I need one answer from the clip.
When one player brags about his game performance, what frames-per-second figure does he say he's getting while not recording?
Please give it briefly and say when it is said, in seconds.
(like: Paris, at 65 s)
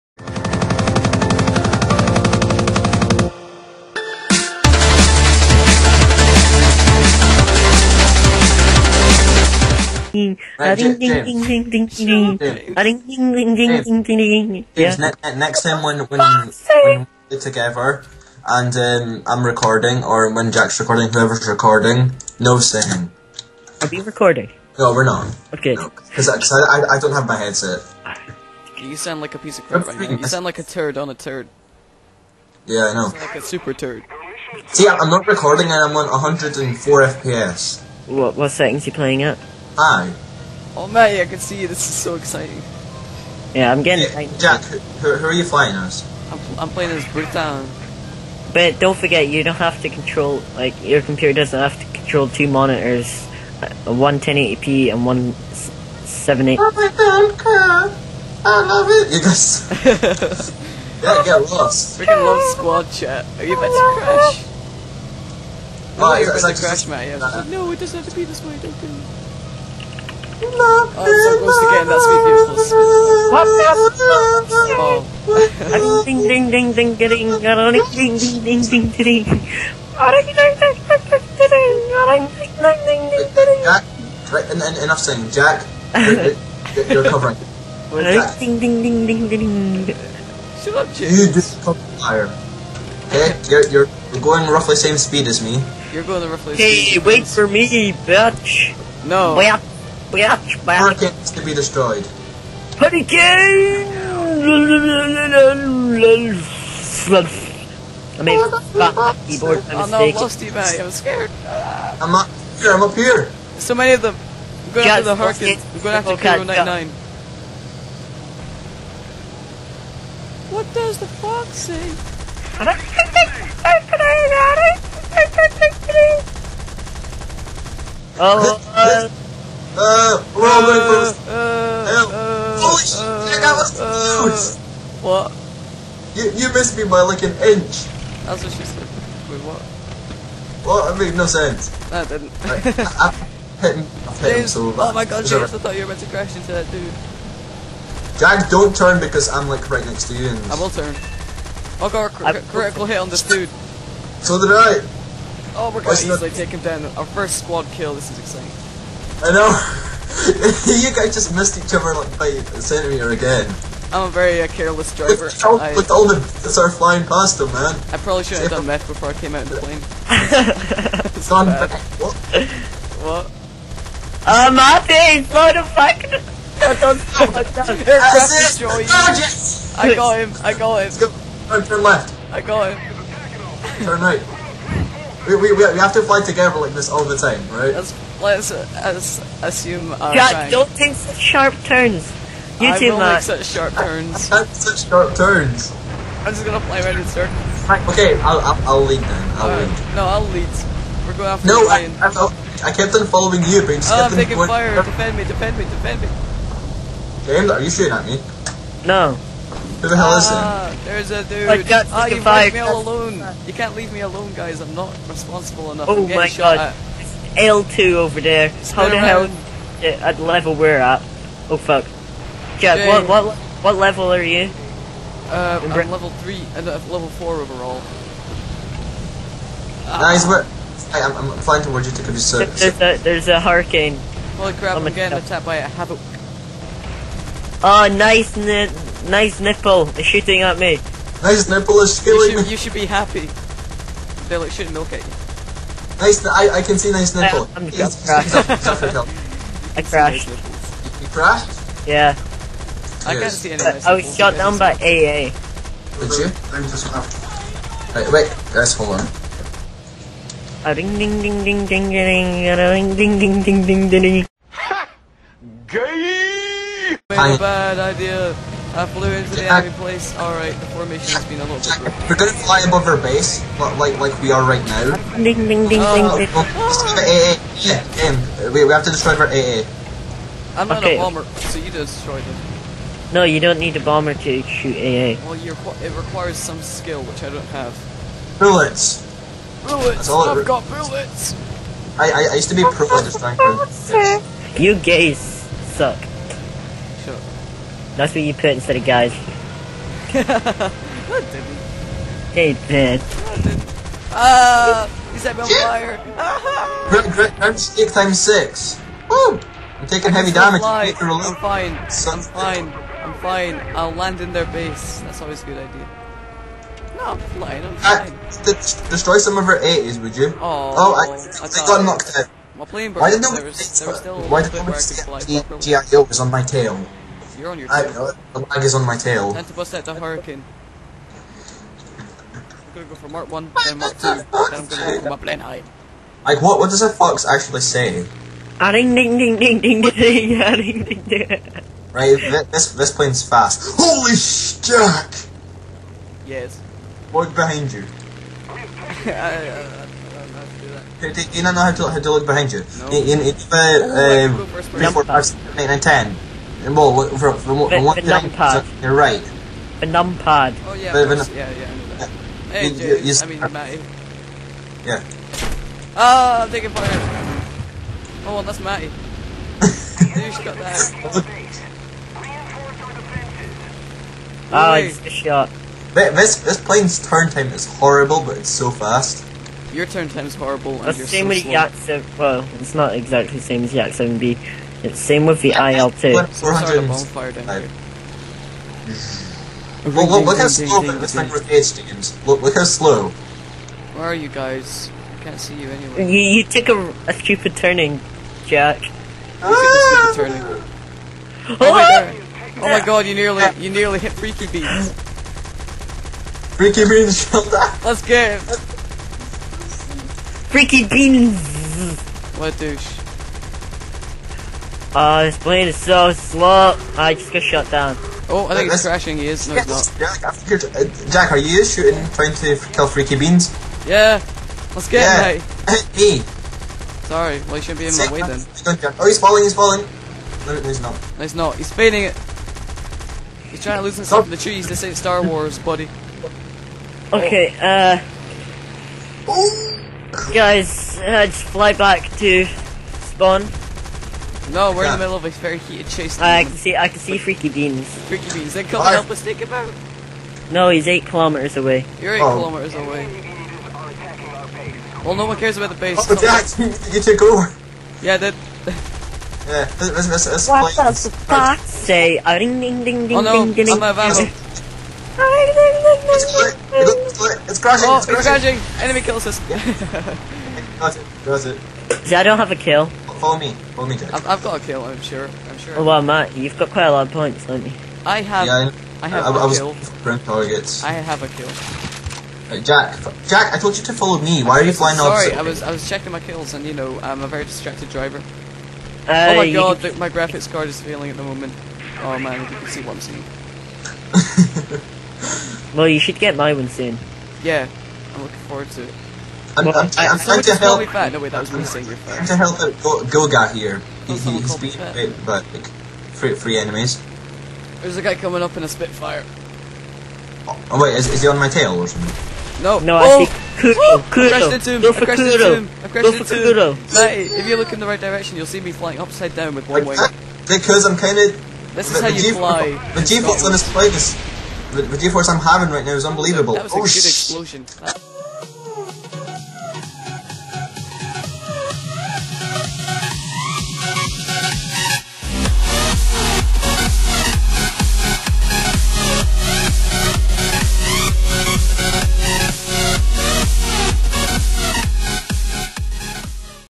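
104 FPS, at 36 s.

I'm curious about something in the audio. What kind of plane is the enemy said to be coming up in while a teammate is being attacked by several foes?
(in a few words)
Spitfire.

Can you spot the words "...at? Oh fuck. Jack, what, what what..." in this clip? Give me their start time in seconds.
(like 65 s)
220 s.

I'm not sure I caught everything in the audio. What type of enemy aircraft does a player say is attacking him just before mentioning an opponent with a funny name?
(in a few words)
Havoc.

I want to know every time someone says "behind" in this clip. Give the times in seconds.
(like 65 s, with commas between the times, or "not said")
347 s, 352 s.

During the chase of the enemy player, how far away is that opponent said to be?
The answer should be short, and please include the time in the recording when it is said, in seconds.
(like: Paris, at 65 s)
8 kilometers, at 450 s.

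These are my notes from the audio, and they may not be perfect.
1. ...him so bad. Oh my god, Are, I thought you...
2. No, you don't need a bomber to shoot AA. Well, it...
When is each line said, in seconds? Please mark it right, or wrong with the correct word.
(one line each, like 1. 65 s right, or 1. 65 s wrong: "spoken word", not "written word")
1. 144 s wrong: "James", not "Are"
2. 283 s right.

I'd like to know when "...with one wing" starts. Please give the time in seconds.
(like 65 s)
519 s.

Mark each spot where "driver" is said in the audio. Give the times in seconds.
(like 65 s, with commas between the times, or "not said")
164 s, 487 s.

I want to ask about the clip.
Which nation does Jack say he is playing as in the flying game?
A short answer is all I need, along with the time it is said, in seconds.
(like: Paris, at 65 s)
Britain, at 47 s.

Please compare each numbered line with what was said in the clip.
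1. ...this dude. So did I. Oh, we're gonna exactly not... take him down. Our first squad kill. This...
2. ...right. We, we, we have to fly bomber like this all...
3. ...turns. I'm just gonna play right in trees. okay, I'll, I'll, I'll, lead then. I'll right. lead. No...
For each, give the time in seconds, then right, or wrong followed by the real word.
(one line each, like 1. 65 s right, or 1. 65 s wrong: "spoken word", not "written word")
1. 153 s wrong: "easily", not "exactly"
2. 184 s wrong: "together", not "bomber"
3. 195 s wrong: "circles", not "trees".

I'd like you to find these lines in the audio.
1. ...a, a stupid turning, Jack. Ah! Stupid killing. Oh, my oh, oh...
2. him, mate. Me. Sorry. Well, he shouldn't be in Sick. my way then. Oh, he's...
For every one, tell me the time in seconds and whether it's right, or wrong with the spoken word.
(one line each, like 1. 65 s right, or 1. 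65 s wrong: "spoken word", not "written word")
1. 396 s wrong: "turning", not "killing"
2. 425 s right.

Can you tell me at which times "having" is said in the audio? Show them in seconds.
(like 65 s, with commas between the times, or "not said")
525 s.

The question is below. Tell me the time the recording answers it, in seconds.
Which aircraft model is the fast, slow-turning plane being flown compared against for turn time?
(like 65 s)
381 s.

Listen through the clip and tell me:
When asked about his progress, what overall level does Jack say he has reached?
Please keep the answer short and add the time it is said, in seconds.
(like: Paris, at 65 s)
4, at 226 s.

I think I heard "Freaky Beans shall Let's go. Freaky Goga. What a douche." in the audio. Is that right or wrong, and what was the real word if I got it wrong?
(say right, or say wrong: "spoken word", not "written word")
wrong: "Beans", not "Goga".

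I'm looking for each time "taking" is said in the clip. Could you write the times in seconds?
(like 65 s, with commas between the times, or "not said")
204 s, 309 s, 366 s.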